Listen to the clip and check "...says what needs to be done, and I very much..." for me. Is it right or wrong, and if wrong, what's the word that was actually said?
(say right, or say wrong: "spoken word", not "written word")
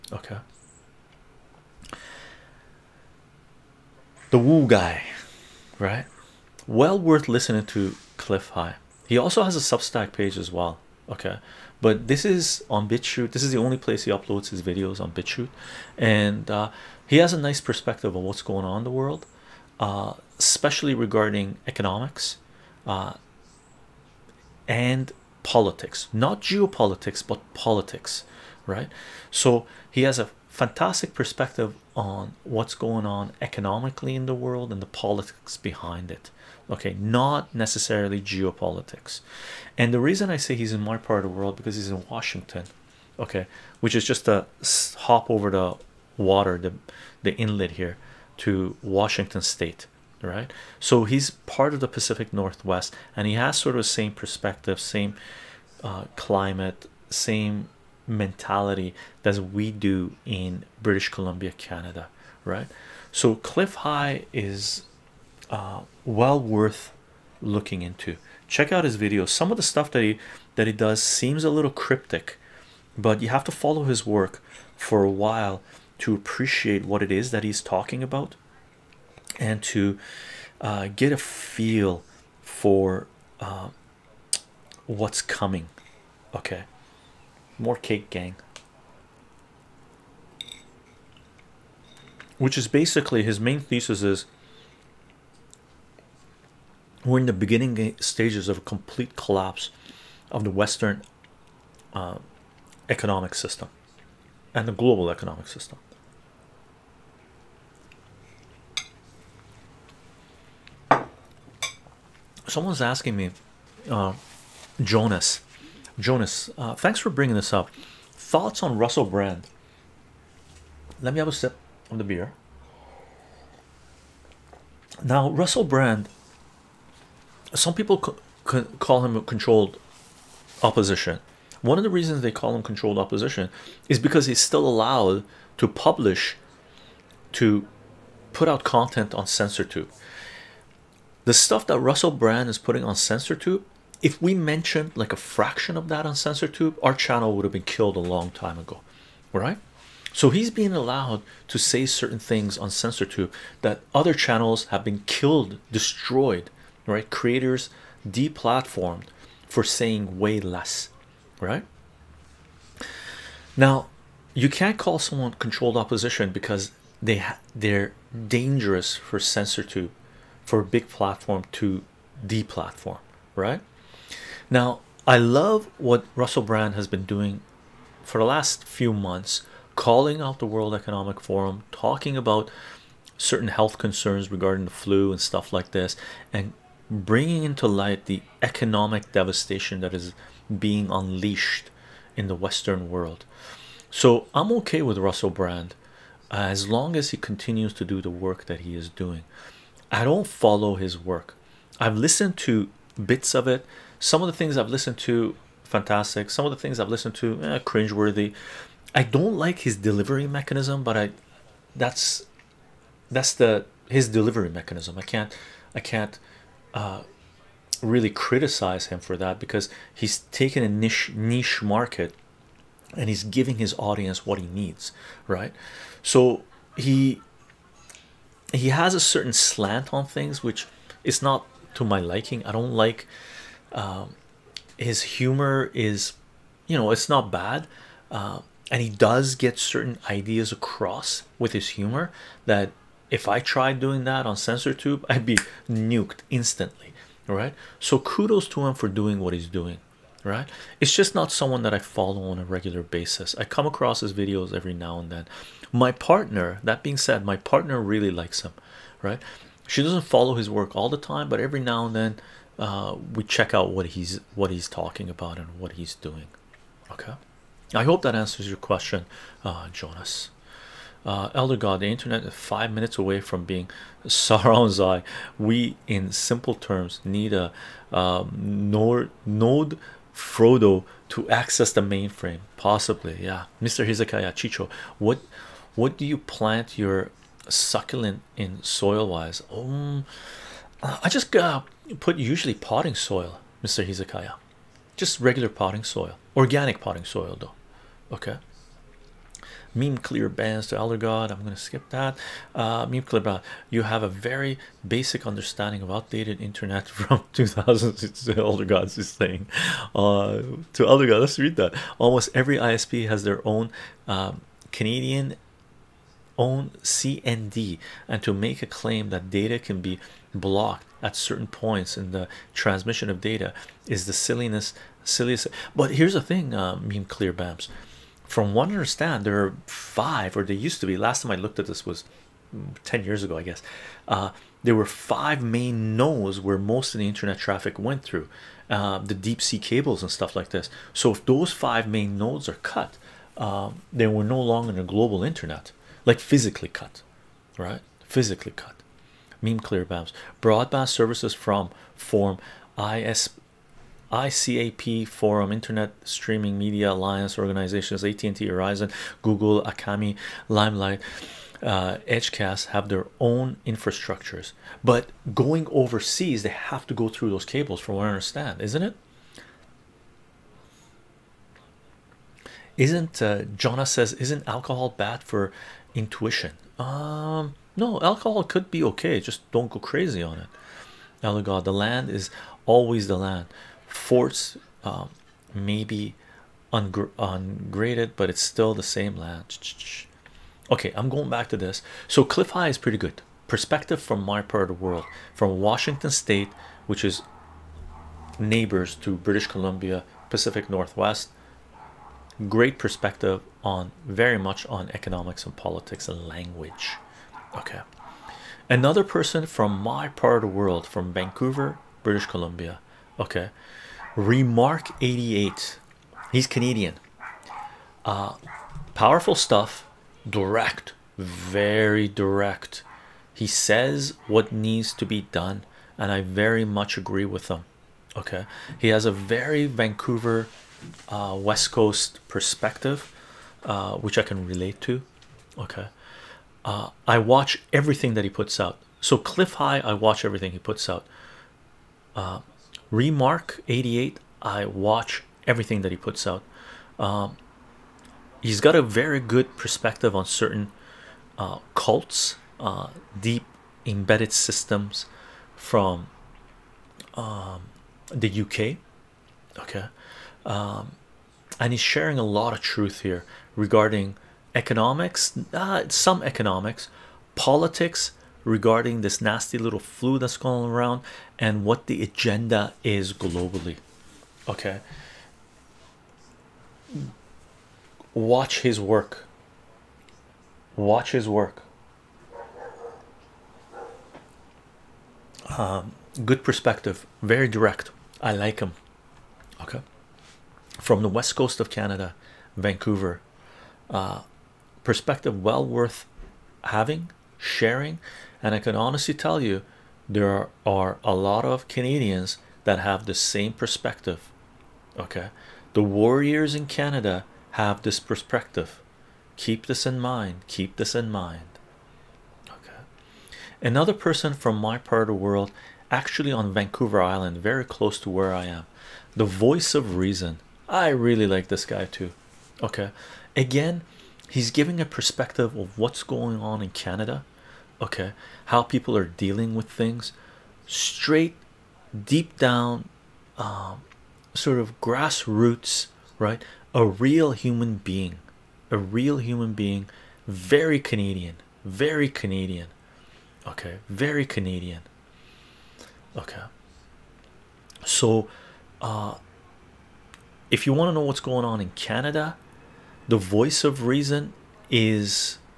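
right.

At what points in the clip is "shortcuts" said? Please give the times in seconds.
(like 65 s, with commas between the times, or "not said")
not said.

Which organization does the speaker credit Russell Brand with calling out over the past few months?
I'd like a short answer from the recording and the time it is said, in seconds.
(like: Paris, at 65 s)
World Economic Forum, at 180 s.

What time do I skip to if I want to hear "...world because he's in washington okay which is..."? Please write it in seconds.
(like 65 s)
41 s.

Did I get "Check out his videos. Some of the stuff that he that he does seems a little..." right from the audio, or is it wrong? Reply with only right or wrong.
right.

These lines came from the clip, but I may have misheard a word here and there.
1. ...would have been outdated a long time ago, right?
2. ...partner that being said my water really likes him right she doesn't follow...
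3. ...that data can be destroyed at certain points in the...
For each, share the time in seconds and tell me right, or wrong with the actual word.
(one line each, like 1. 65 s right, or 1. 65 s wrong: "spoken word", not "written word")
1. 147 s wrong: "killed", not "outdated"
2. 255 s wrong: "partner", not "water"
3. 319 s wrong: "blocked", not "destroyed".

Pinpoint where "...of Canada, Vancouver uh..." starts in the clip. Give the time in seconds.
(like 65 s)
491 s.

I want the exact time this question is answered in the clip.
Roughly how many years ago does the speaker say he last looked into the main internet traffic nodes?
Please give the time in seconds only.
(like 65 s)
332 s.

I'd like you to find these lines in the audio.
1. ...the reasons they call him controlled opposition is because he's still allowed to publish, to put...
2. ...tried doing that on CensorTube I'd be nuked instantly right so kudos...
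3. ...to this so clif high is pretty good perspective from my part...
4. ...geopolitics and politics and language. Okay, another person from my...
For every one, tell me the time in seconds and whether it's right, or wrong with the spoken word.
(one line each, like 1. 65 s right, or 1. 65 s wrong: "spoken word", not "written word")
1. 131 s right
2. 243 s right
3. 391 s right
4. 404 s wrong: "economics", not "geopolitics".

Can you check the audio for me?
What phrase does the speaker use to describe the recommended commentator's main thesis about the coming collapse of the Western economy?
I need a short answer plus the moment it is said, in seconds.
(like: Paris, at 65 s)
more cake gang, at 87 s.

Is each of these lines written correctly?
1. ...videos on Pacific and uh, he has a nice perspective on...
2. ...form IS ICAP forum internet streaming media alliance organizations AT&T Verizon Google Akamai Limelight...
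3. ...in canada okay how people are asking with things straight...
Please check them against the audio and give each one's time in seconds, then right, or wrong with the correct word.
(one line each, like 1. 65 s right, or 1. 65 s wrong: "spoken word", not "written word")
1. 14 s wrong: "BitChute", not "Pacific"
2. 351 s right
3. 526 s wrong: "dealing", not "asking".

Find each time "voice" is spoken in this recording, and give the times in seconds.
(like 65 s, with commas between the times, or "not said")
519 s, 553 s.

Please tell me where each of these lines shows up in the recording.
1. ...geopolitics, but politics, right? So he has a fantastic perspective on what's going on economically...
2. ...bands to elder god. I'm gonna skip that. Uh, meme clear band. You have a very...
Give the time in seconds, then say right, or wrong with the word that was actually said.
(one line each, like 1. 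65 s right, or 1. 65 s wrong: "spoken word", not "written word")
1. 26 s right
2. 300 s right.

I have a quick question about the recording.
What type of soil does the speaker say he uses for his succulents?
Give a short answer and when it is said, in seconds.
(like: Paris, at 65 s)
Organic potting soil, at 296 s.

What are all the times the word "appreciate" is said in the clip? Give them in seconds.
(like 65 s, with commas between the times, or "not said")
76 s.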